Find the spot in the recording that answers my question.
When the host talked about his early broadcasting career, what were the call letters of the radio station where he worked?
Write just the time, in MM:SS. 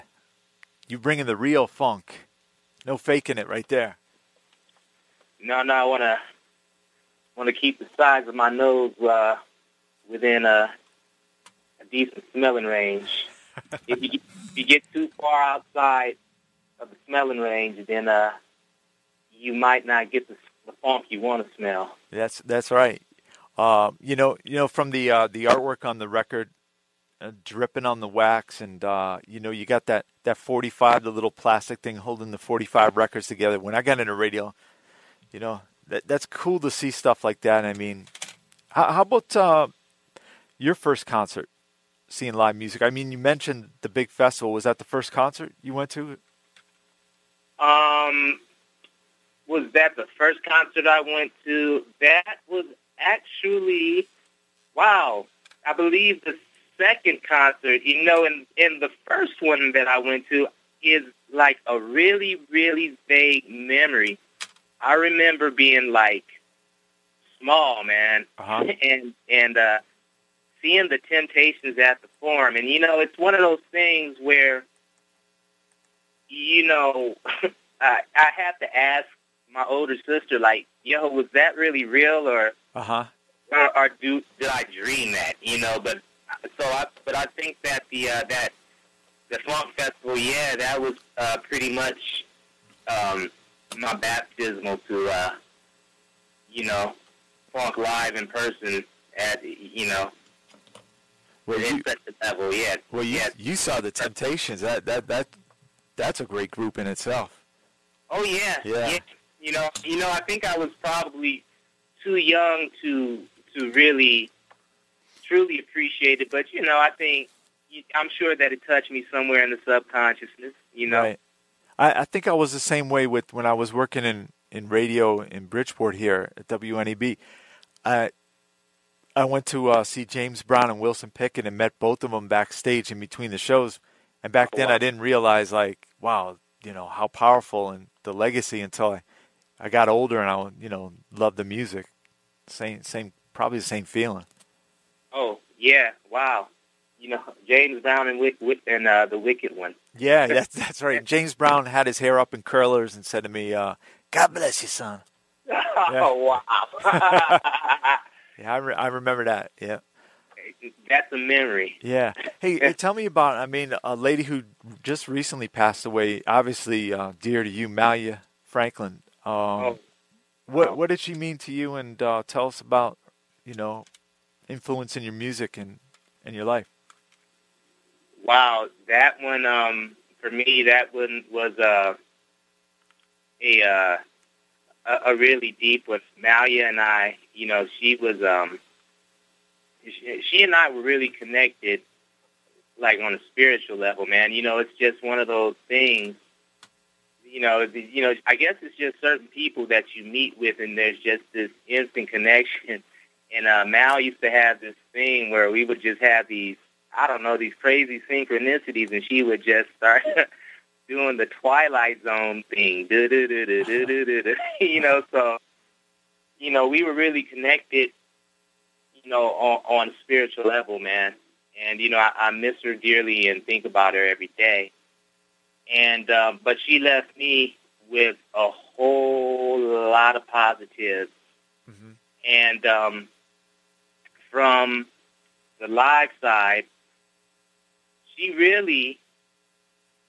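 02:06.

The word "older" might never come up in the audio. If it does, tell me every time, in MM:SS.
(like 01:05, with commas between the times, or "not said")
01:19, 02:19.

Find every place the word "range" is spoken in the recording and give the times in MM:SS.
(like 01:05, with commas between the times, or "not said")
00:12, 00:17.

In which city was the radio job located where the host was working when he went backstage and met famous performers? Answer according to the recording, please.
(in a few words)
Bridgeport.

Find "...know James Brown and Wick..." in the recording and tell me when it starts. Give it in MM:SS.
02:27.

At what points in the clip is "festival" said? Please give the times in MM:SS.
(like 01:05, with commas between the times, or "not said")
00:44, 01:29.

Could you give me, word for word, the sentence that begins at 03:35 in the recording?
So, you know, we were really connected, you know, on, on a spiritual level, man.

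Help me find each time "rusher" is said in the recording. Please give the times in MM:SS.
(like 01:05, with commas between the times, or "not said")
not said.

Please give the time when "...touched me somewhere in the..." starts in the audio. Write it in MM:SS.
01:58.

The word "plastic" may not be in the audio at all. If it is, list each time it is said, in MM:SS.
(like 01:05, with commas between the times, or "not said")
00:31.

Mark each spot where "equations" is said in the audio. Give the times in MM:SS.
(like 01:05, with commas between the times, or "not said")
not said.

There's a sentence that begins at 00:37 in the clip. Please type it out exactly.
I mean, how, how about uh, your first concert seeing live music?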